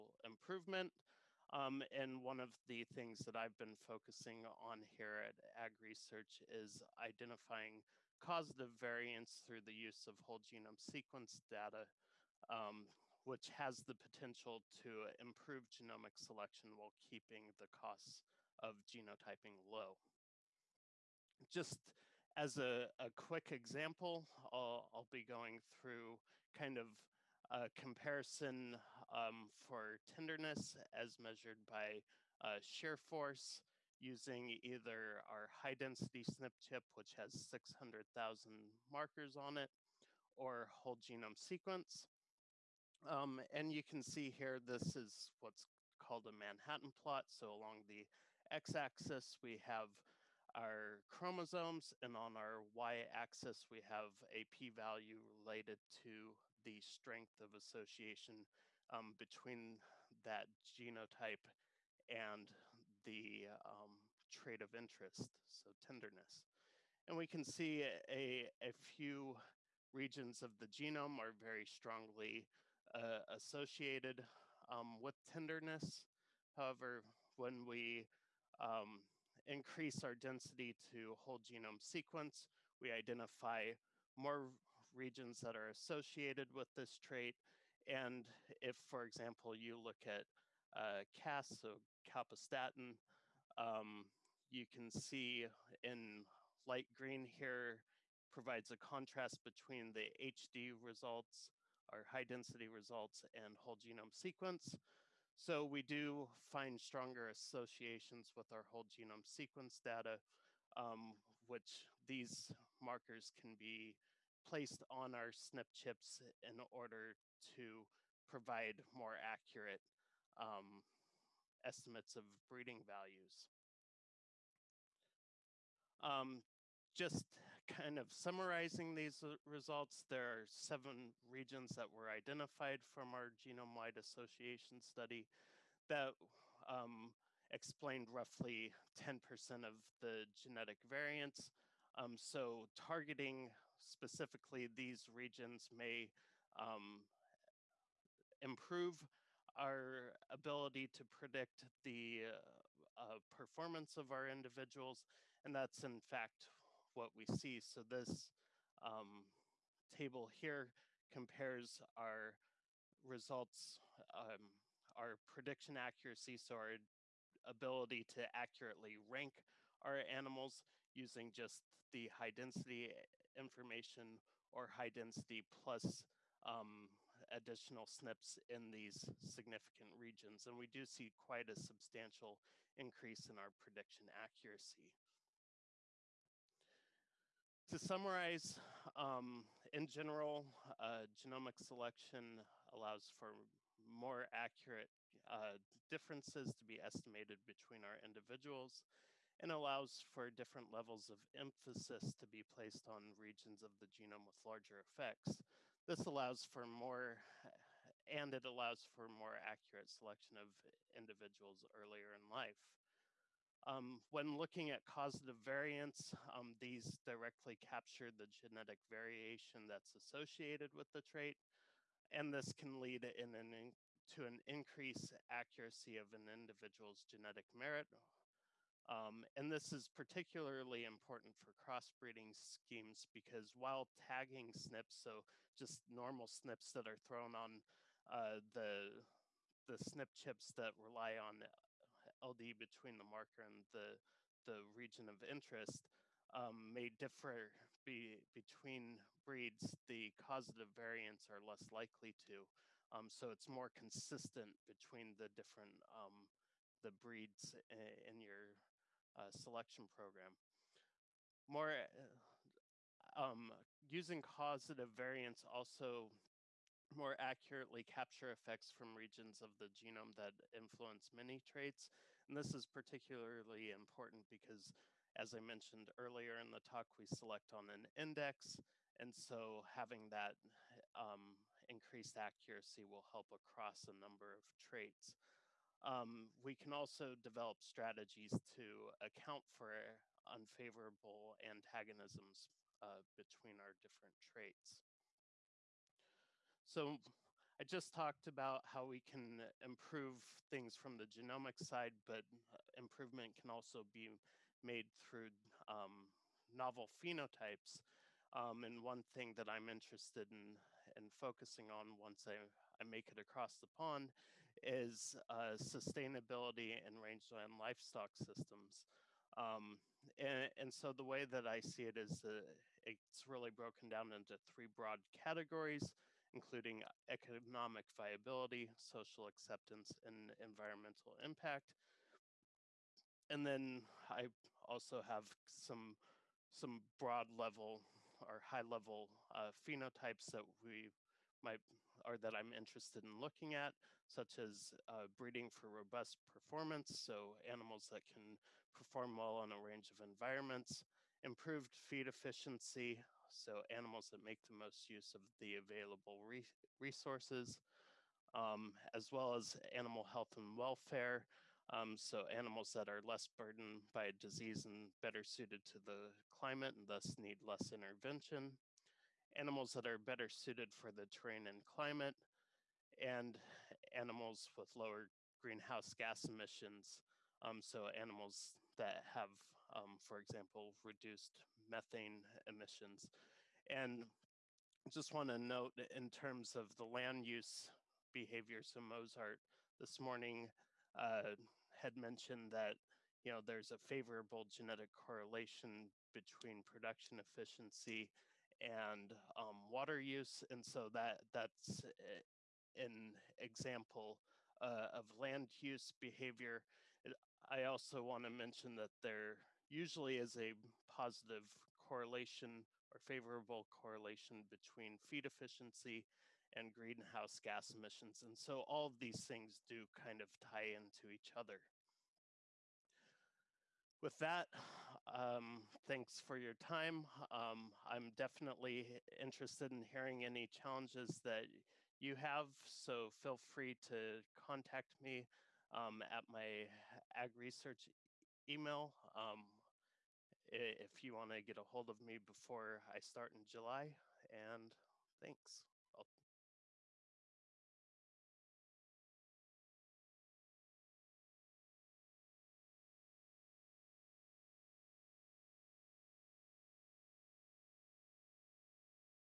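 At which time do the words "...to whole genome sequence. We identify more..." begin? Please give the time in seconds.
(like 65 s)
80 s.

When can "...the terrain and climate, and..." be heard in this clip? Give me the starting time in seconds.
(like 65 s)
370 s.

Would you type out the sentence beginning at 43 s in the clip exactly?
Um, and you can see here, this is what's called a Manhattan plot.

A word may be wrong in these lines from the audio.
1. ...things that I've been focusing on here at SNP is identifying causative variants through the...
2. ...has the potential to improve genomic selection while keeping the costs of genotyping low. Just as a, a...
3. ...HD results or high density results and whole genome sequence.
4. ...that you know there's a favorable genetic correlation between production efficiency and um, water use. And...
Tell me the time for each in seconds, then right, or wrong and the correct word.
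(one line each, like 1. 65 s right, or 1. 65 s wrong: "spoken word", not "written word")
1. 2 s wrong: "AgResearch", not "SNP"
2. 13 s right
3. 100 s right
4. 392 s right.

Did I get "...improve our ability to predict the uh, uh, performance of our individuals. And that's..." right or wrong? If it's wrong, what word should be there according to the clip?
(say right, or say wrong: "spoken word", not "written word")
right.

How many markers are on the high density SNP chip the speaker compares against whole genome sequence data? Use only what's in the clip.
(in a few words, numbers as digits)
600,000.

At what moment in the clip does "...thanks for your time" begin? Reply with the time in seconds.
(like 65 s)
425 s.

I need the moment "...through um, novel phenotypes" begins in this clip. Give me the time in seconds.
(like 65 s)
304 s.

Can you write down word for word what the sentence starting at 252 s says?
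Um, so it's more consistent between the different um, the breeds in, in your uh, selection program.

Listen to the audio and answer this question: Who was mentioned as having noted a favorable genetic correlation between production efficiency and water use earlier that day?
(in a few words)
Mozart.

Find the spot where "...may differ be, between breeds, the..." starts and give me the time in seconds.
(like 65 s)
246 s.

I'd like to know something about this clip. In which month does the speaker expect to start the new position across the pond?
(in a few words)
July.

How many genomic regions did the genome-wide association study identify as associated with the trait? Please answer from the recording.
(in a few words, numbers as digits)
Seven.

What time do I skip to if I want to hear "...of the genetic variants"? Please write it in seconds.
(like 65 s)
139 s.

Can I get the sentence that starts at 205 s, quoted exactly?
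This allows for more, and it allows for more accurate selection of individuals earlier in life.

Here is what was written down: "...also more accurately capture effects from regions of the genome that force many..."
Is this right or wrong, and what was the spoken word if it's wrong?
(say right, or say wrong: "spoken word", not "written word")
wrong: "influence", not "force".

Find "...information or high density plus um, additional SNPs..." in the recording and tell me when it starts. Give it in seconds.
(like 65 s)
173 s.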